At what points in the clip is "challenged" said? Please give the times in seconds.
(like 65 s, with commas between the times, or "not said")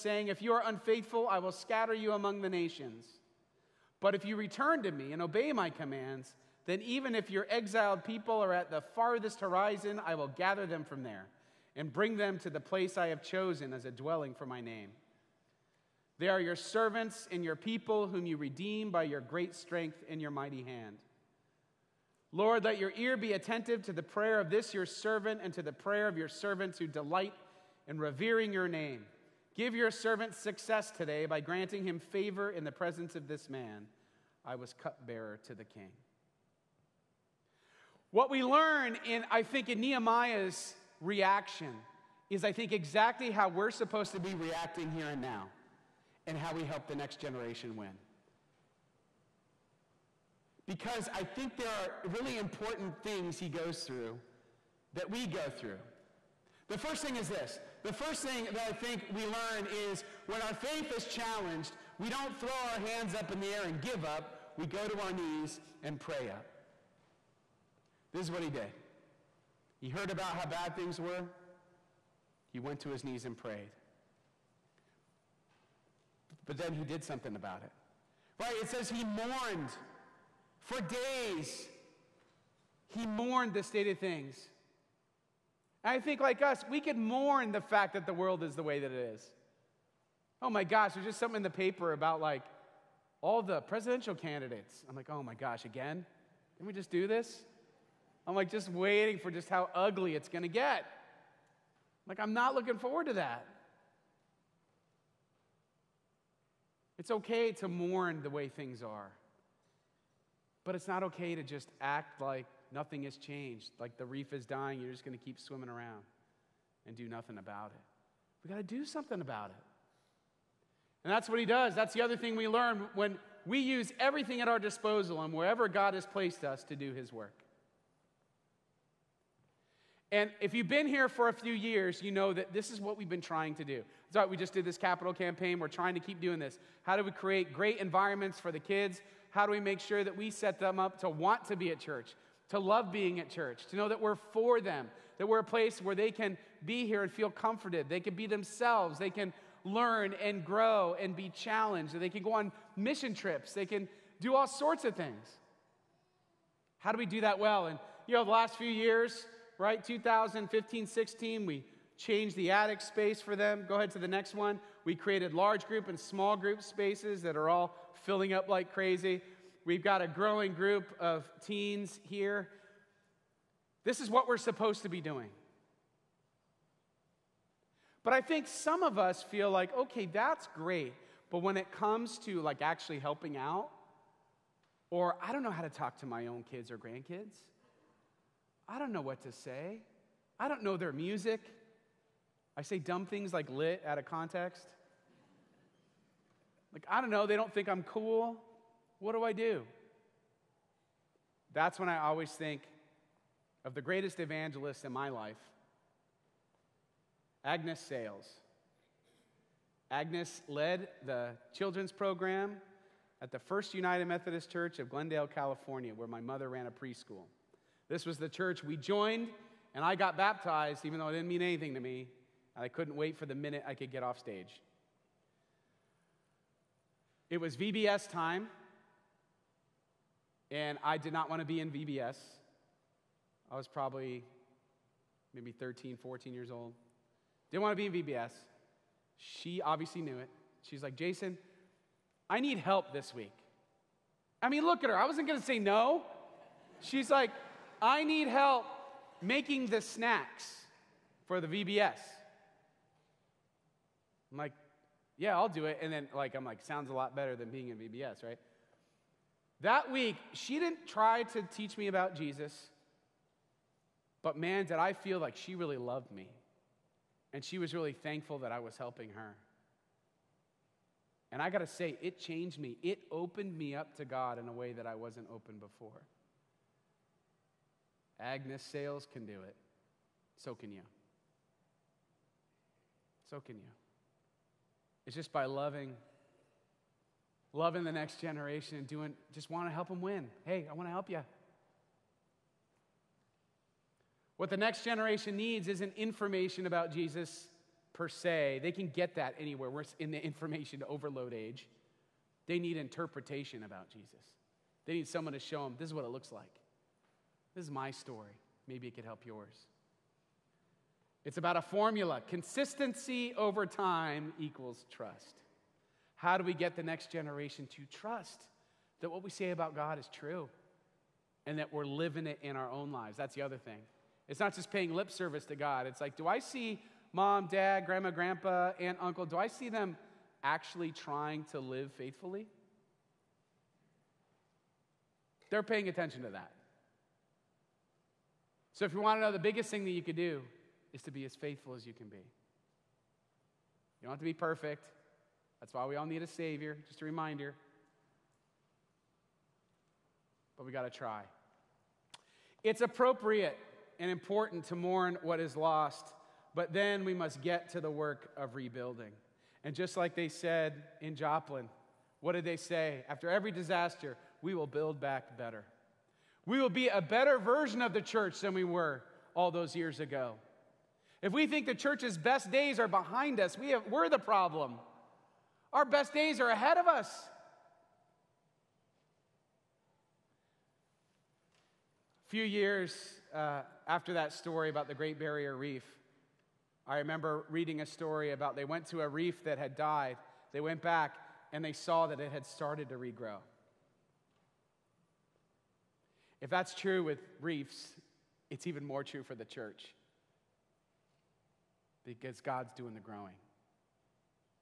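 61 s, 151 s.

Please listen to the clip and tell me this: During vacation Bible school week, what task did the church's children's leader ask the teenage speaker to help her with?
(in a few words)
making the snacks.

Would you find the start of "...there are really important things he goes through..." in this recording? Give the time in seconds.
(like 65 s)
51 s.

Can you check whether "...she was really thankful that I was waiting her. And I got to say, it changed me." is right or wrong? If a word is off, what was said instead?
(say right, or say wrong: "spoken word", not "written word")
wrong: "helping", not "waiting".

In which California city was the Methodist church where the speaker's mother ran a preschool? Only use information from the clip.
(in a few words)
Glendale.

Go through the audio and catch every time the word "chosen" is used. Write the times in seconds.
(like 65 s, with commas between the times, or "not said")
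13 s.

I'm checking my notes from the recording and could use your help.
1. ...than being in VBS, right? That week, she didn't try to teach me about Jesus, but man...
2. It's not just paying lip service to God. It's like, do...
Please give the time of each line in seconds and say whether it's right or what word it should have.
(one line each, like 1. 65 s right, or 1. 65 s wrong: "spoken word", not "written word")
1. 257 s right
2. 324 s right.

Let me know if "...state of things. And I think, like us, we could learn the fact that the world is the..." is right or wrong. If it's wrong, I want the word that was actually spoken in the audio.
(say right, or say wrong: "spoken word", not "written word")
wrong: "mourn", not "learn".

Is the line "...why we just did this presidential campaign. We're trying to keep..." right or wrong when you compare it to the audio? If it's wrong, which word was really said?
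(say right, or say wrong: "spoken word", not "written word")
wrong: "capital", not "presidential".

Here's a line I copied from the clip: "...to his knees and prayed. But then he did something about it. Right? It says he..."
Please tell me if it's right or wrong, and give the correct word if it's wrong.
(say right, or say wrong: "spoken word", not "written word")
right.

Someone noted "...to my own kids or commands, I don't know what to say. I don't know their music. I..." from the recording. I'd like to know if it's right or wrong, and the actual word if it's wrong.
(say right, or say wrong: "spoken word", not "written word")
wrong: "grandkids", not "commands".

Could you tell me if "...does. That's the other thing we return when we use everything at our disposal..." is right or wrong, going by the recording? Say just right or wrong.
wrong.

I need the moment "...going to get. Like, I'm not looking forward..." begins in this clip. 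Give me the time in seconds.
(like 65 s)
100 s.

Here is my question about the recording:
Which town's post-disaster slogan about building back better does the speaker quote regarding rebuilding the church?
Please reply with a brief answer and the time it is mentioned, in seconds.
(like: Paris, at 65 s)
Joplin, at 361 s.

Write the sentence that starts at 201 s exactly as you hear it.
That's when I always think of the greatest evangelist in my life, Agnes Sales.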